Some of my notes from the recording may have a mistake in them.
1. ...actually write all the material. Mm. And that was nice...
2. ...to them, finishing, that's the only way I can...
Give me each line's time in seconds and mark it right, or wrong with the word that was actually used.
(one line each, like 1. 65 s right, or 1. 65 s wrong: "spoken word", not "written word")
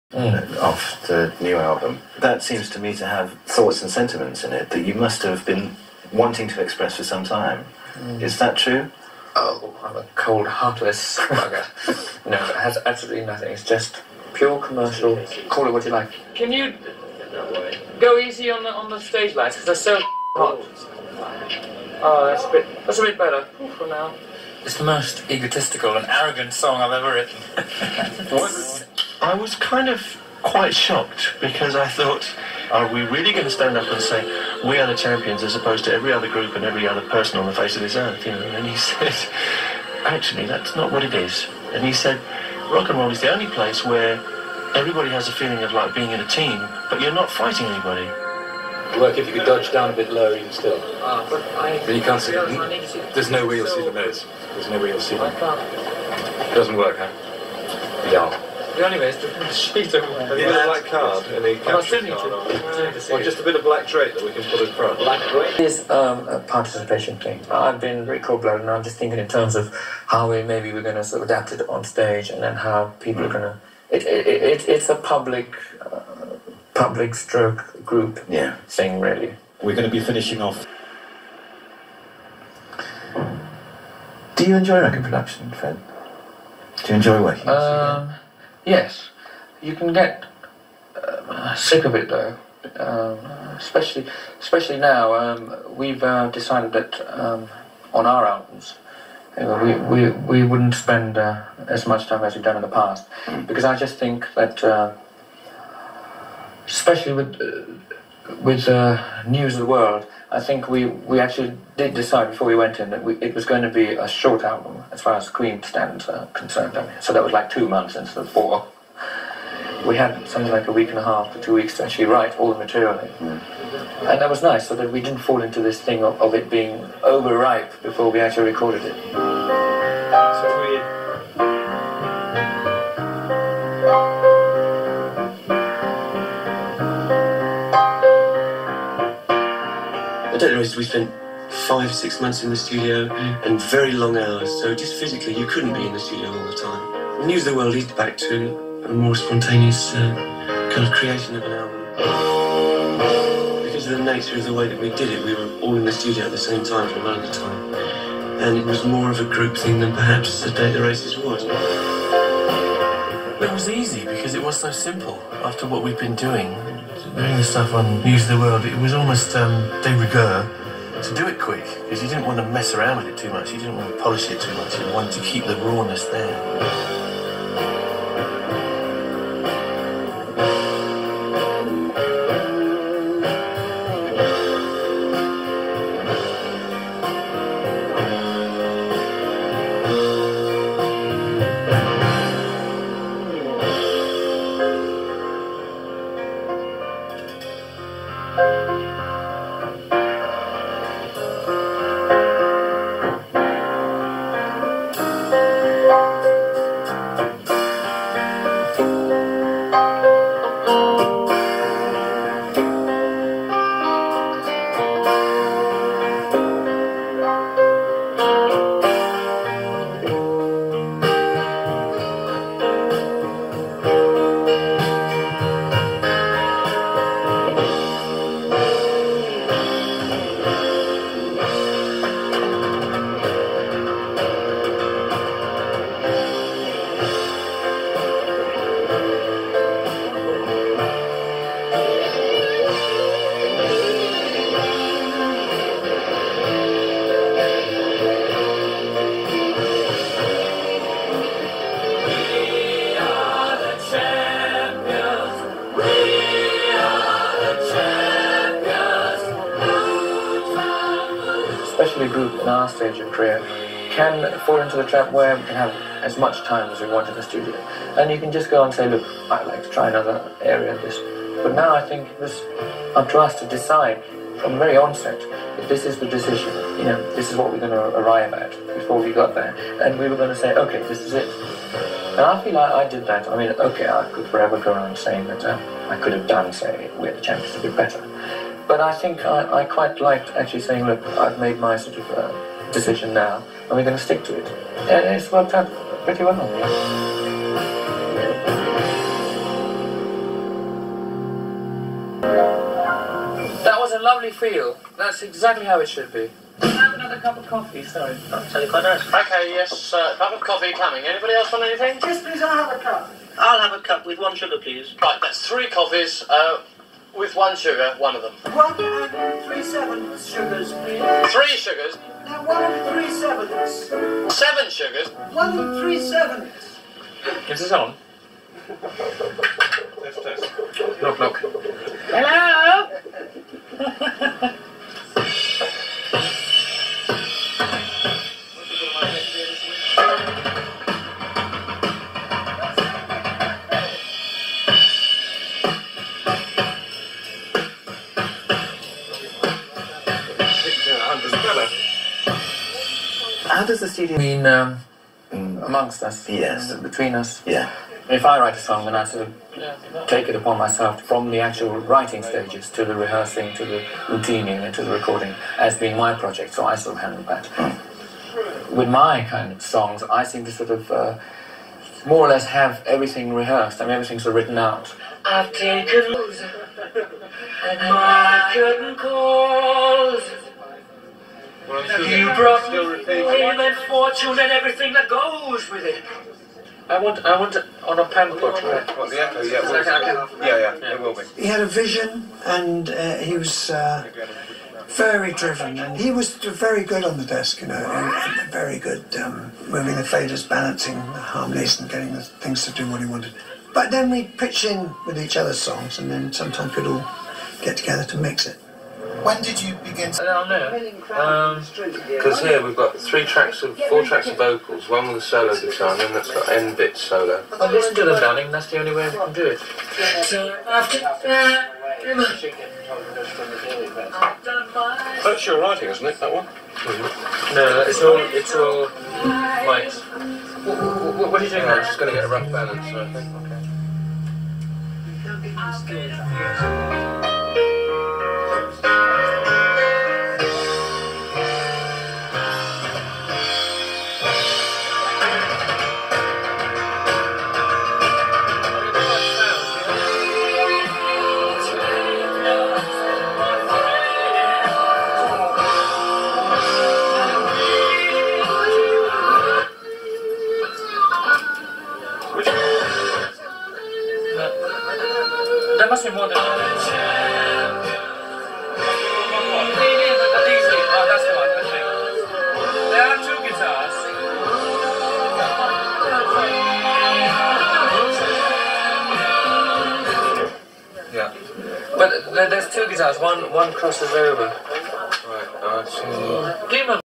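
1. 121 s right
2. 417 s wrong: "darling", not "finishing".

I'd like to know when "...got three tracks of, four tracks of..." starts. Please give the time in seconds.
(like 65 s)
412 s.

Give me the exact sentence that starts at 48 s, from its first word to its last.
Work if you could dodge down a bit lower, even still.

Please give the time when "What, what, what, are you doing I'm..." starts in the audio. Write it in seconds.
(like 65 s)
430 s.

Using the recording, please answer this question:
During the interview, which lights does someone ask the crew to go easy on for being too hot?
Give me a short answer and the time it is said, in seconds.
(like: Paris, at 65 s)
stage lights, at 18 s.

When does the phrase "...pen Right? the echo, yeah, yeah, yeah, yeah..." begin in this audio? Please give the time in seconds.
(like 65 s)
388 s.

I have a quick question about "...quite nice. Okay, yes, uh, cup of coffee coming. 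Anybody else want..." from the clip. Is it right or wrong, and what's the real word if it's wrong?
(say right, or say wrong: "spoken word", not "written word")
right.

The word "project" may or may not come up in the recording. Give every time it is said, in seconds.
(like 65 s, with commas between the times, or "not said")
366 s.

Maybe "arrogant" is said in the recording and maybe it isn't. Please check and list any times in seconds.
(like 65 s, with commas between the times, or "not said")
26 s.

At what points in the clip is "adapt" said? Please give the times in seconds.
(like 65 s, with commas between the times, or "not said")
71 s.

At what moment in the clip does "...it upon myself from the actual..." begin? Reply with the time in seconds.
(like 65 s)
360 s.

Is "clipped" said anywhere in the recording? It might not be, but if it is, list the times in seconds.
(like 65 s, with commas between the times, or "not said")
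not said.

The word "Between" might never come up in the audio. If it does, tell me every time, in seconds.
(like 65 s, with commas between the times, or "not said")
356 s.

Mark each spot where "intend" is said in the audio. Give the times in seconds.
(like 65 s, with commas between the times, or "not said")
not said.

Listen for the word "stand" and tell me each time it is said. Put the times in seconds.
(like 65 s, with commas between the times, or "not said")
33 s, 115 s.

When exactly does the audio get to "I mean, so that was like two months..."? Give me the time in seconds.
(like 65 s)
116 s.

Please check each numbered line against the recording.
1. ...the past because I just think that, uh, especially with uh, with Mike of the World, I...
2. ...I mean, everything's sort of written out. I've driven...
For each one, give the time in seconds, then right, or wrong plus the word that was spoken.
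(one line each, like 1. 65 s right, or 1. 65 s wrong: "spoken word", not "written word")
1. 102 s wrong: "News", not "Mike"
2. 373 s wrong: "taken", not "driven".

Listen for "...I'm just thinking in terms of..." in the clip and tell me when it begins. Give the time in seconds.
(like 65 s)
68 s.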